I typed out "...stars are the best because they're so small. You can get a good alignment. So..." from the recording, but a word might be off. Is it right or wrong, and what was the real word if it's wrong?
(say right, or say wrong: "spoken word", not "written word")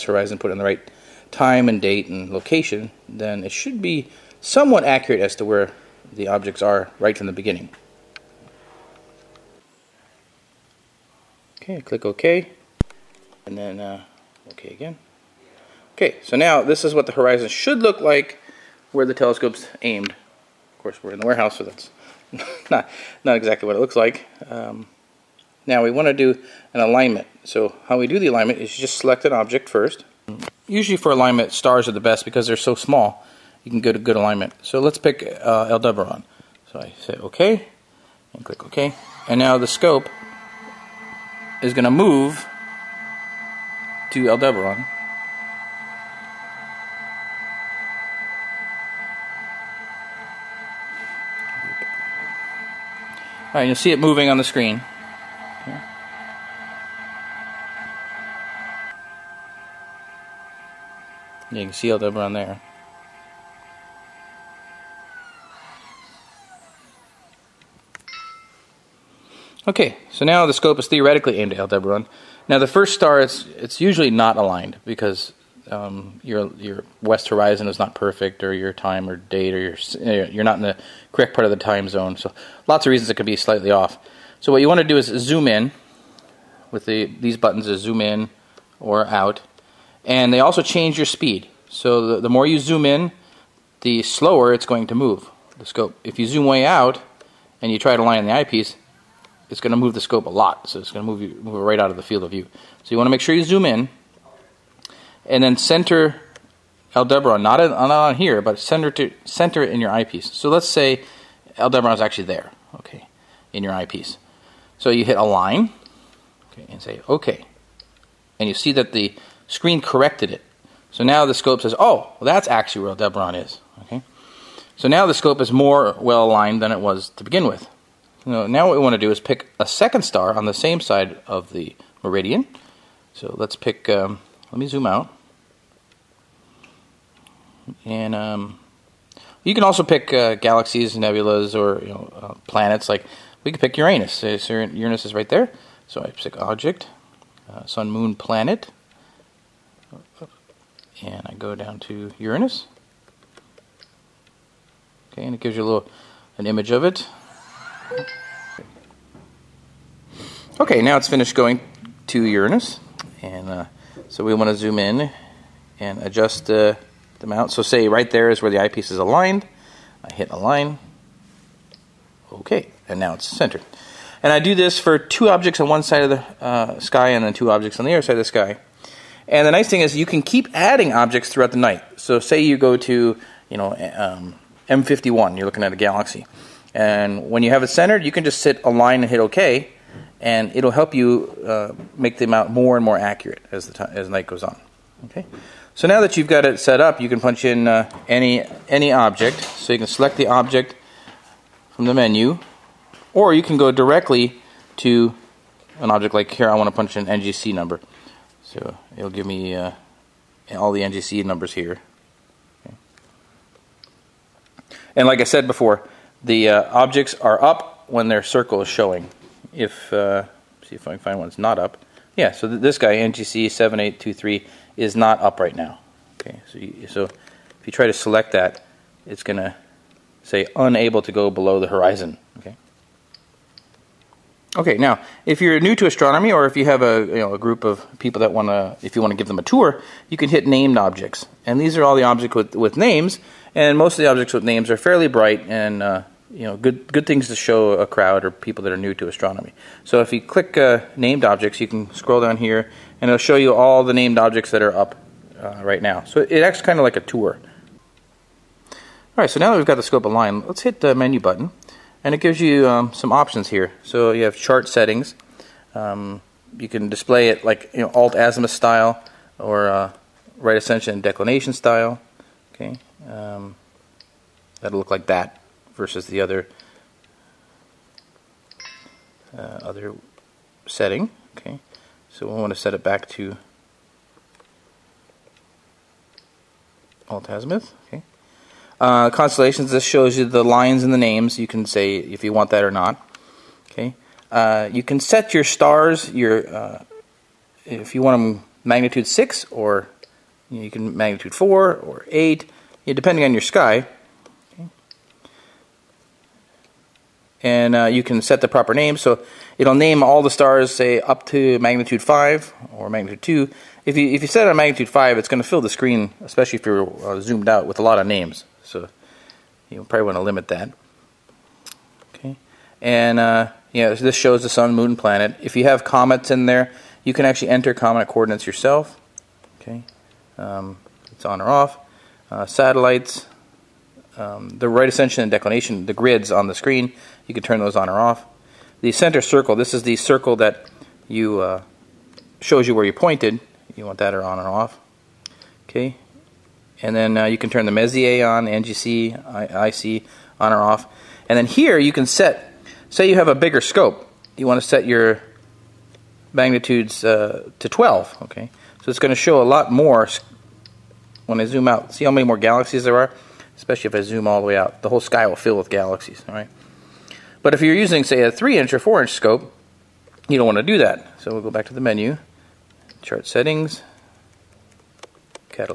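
right.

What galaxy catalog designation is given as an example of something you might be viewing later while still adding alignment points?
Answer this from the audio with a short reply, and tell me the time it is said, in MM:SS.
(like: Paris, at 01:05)
M51, at 03:04.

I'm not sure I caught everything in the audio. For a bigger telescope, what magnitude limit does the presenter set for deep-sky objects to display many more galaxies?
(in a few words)
12.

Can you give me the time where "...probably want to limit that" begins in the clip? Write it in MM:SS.
05:19.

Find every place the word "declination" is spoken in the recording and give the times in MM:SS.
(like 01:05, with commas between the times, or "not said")
04:31, 05:35.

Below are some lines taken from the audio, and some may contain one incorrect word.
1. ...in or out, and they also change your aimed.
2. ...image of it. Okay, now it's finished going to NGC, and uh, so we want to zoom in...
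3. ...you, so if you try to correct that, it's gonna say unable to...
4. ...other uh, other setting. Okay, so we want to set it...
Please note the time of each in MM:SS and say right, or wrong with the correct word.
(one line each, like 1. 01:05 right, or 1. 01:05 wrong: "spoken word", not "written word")
1. 01:27 wrong: "speed", not "aimed"
2. 02:36 wrong: "Uranus", not "NGC"
3. 03:46 wrong: "select", not "correct"
4. 04:36 right.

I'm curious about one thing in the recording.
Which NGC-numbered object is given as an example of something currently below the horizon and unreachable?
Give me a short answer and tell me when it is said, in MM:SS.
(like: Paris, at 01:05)
NGC 7823, at 03:42.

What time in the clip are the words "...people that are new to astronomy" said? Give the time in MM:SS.
04:08.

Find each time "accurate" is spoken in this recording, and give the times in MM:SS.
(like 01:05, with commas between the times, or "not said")
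00:04, 03:12.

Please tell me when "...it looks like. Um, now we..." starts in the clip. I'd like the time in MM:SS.
00:23.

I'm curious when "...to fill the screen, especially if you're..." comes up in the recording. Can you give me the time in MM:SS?
05:15.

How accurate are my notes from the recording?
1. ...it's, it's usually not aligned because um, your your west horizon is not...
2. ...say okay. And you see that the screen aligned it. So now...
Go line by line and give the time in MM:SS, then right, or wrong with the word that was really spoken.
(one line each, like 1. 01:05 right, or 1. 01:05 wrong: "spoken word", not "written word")
1. 01:13 right
2. 01:56 wrong: "corrected", not "aligned".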